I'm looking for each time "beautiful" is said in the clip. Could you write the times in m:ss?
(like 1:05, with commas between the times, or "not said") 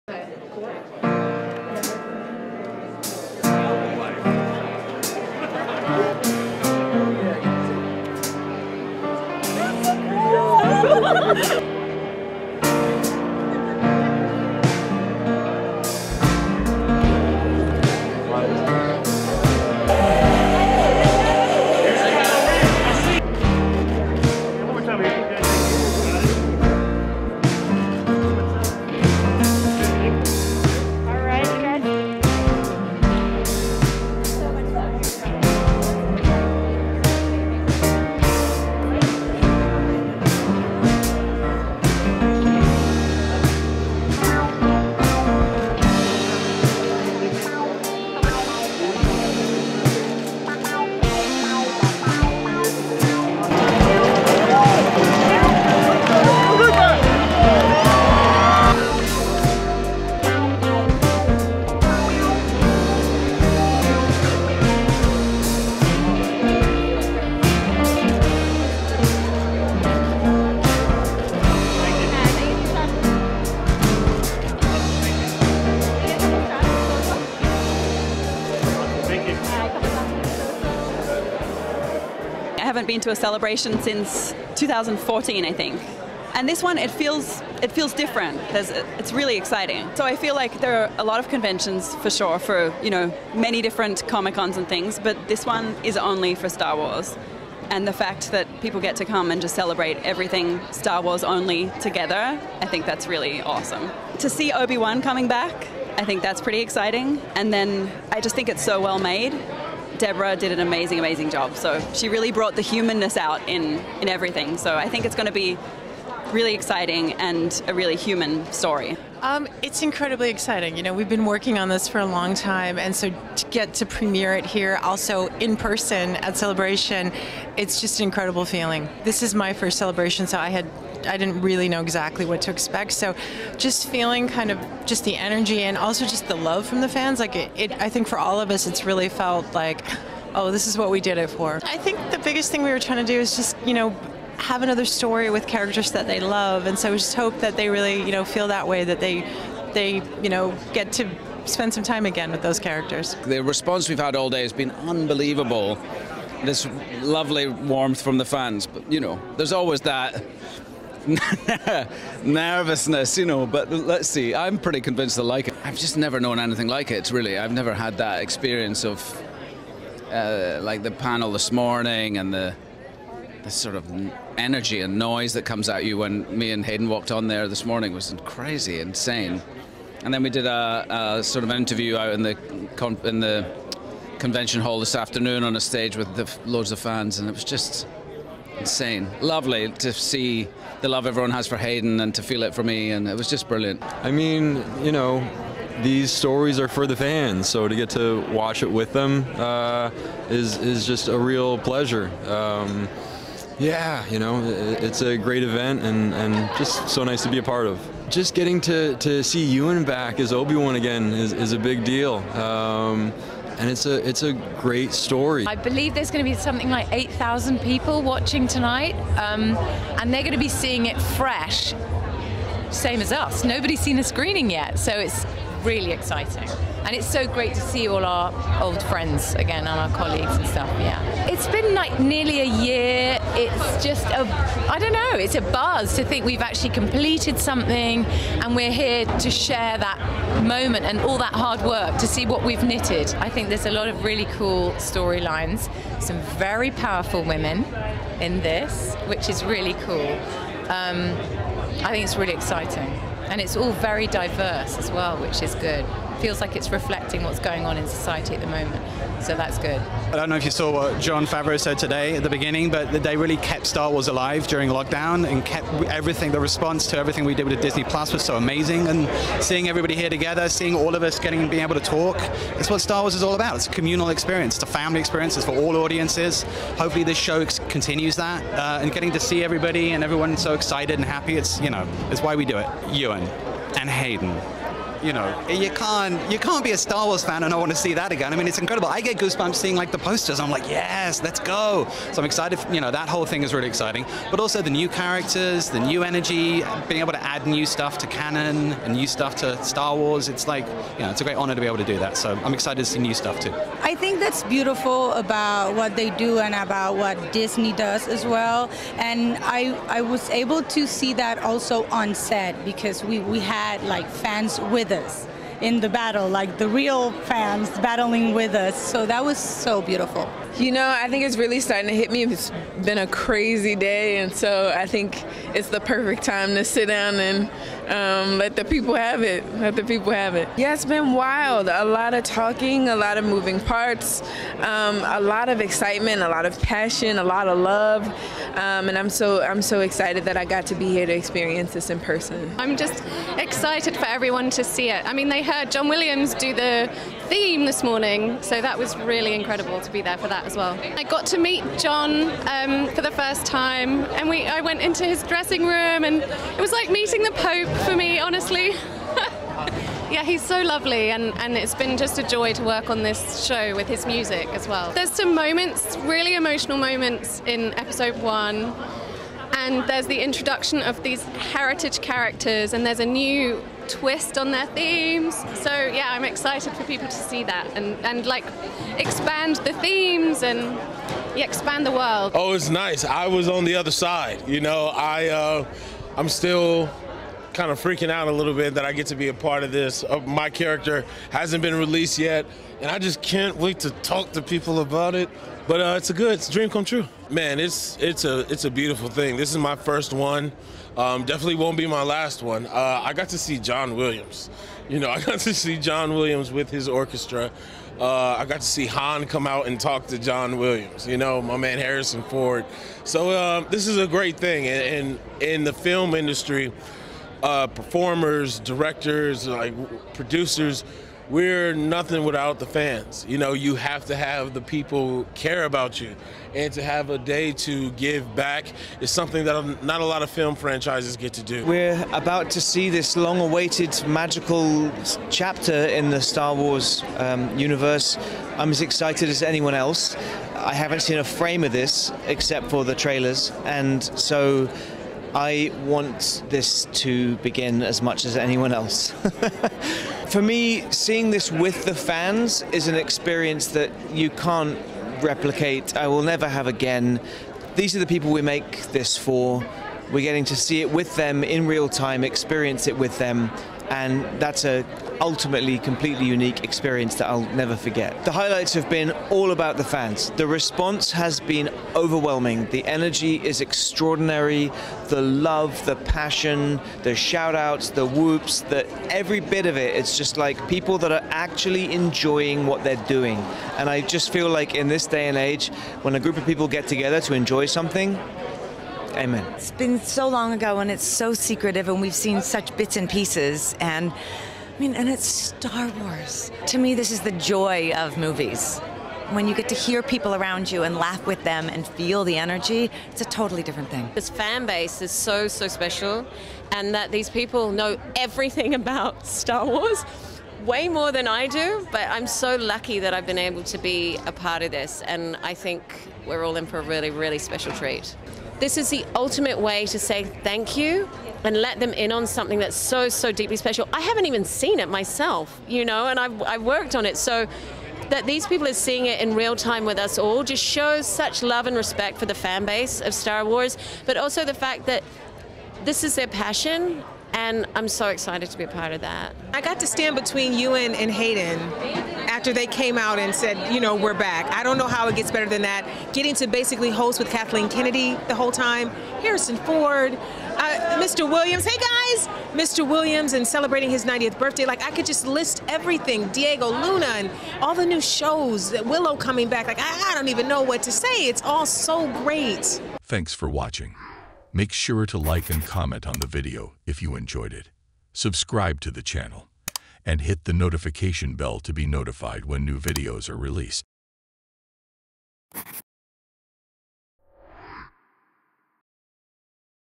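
5:04, 5:19, 6:38.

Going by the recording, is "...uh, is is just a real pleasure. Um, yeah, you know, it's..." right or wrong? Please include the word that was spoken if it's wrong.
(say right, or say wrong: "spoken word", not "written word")
right.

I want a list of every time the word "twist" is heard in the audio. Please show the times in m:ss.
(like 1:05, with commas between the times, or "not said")
6:13.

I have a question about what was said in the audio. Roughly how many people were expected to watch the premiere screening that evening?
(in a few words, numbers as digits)
8,000.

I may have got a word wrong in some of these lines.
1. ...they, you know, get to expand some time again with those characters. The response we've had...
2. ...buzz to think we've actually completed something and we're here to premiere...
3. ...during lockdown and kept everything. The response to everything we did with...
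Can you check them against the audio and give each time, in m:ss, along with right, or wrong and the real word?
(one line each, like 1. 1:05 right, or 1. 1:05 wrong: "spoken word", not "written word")
1. 2:29 wrong: "spend", not "expand"
2. 3:55 wrong: "share", not "premiere"
3. 4:24 right.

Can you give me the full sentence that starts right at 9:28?
Subscribe to the channel and hit the notification bell to be notified when new videos are released.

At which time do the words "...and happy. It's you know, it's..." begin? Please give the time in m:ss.
4:40.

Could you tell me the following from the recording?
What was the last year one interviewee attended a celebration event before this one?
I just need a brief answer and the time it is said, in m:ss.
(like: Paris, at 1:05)
2014, at 1:24.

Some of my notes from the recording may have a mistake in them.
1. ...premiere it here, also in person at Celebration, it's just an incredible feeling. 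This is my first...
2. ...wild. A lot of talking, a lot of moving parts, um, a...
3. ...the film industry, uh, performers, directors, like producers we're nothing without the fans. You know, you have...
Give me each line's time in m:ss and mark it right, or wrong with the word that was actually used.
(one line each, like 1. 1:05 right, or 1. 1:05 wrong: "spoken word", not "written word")
1. 2:03 right
2. 5:31 right
3. 6:55 right.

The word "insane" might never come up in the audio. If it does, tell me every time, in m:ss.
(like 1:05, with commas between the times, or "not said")
2:58, 3:08.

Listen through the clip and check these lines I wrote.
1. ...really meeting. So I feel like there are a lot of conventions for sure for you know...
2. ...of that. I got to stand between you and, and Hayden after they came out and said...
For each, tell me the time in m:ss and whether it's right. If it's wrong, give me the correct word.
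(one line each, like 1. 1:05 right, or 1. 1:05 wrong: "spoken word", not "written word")
1. 1:29 wrong: "exciting", not "meeting"
2. 8:58 right.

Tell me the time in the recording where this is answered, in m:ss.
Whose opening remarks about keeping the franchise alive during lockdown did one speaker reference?
4:21.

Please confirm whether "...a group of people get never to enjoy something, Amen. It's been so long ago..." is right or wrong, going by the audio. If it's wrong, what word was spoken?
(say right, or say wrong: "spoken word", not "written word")
wrong: "together", not "never".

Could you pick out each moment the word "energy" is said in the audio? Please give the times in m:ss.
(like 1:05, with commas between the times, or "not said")
2:15, 2:54, 4:56, 7:52, 8:22.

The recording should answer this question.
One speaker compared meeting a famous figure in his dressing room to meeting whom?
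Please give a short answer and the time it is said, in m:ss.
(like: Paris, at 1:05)
the Pope, at 5:57.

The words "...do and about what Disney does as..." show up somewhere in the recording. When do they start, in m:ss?
5:06.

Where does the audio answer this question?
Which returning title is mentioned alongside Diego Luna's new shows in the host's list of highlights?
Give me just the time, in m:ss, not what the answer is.
9:18.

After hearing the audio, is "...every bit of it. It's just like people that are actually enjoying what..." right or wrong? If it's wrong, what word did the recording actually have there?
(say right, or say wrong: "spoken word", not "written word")
right.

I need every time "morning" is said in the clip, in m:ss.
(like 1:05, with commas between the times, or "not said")
2:51, 2:57, 5:47.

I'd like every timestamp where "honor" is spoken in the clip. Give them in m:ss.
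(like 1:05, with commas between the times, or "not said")
5:01.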